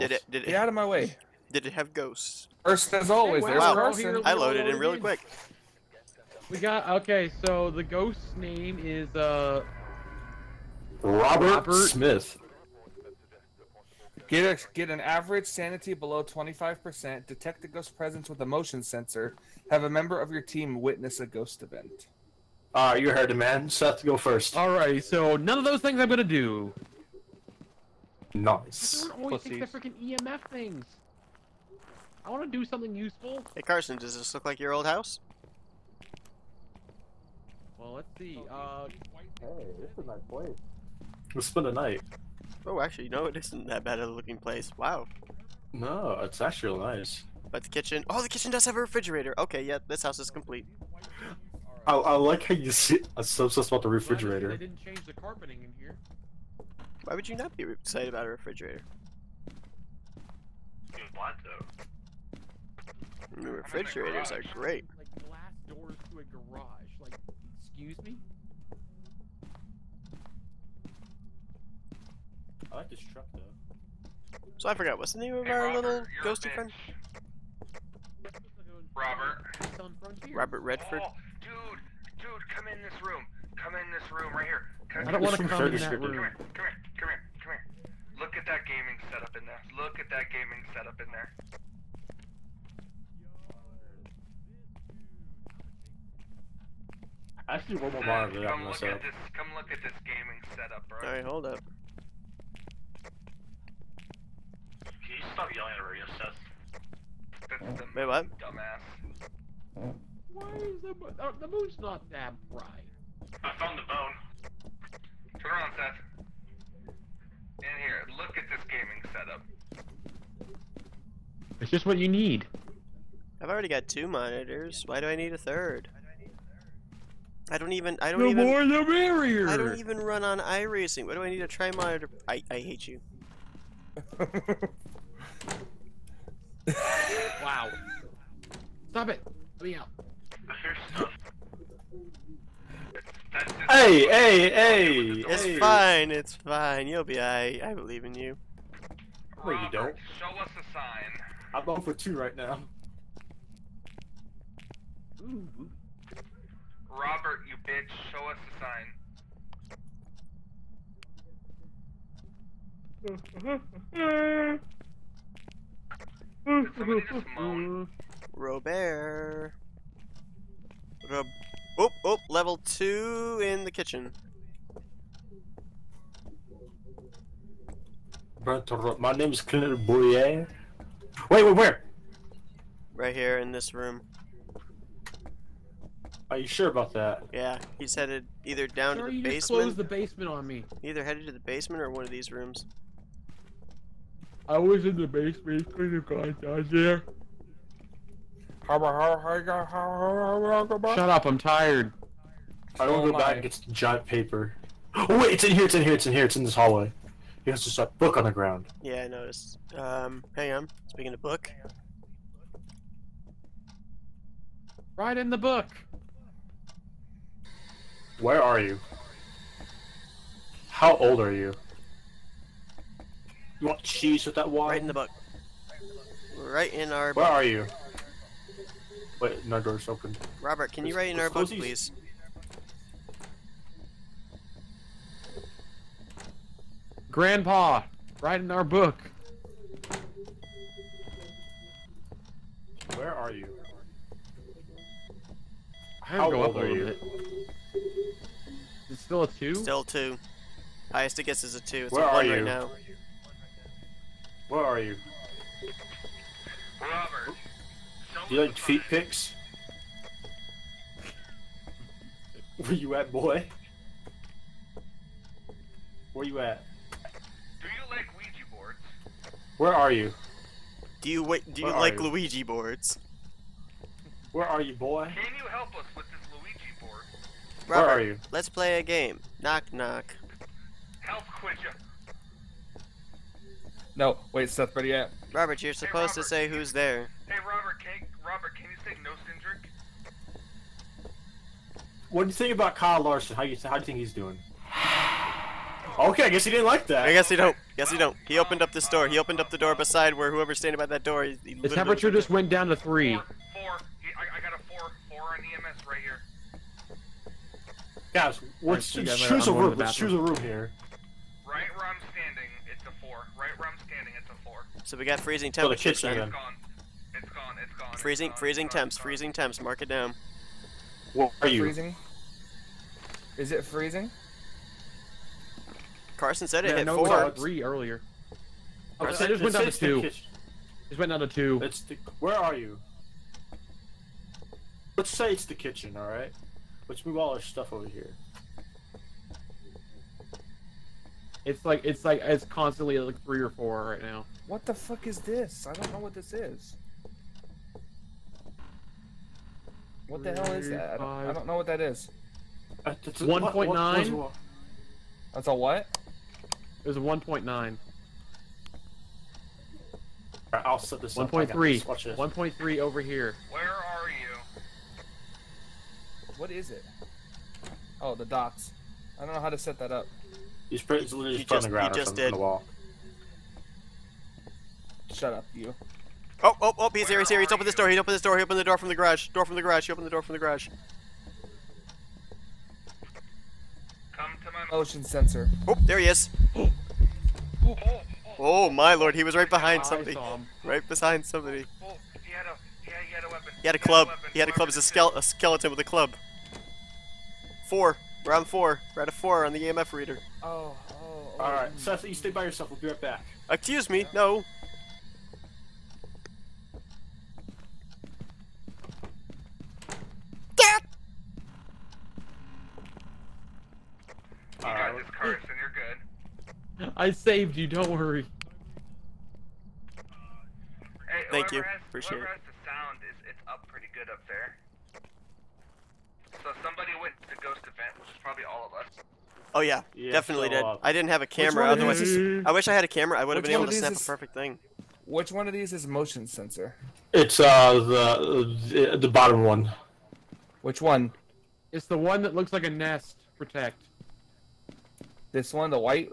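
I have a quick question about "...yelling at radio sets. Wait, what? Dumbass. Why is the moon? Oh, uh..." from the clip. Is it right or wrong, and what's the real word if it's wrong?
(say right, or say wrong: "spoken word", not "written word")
right.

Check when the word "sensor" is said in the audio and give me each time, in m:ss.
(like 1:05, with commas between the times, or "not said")
0:18, 6:25, 7:16.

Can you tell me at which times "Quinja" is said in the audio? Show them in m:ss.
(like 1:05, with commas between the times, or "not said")
4:41.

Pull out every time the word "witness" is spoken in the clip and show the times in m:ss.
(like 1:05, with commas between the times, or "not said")
0:20.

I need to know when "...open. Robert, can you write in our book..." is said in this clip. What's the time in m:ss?
3:49.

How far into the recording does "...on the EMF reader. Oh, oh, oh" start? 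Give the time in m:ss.
6:39.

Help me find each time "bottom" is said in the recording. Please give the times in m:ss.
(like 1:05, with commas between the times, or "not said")
7:19.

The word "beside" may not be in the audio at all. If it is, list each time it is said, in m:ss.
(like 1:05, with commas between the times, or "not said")
4:59.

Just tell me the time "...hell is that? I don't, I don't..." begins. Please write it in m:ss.
5:50.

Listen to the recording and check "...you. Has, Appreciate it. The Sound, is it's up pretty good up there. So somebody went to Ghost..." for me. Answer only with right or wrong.
right.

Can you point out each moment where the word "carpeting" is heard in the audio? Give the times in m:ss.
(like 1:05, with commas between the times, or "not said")
0:55.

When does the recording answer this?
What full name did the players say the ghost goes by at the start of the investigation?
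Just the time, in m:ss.
0:11.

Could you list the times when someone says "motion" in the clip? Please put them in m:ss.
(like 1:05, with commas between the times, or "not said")
0:18, 6:24, 7:15.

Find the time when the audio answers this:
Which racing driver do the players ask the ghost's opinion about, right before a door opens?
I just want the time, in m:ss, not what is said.
4:52.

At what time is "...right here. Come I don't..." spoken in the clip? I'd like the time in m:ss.
1:24.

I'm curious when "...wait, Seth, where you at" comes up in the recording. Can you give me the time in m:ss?
4:44.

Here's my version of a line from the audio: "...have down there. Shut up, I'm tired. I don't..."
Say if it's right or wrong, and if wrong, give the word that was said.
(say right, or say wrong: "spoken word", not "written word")
right.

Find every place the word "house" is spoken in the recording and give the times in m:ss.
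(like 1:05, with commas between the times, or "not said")
0:34, 0:50.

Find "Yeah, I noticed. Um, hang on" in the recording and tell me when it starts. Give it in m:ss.
3:28.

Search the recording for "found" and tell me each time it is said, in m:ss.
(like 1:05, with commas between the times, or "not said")
1:53.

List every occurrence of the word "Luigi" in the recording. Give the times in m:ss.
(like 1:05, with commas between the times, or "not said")
4:32, 4:36.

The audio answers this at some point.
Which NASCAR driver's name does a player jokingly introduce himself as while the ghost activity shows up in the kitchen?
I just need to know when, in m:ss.
2:59.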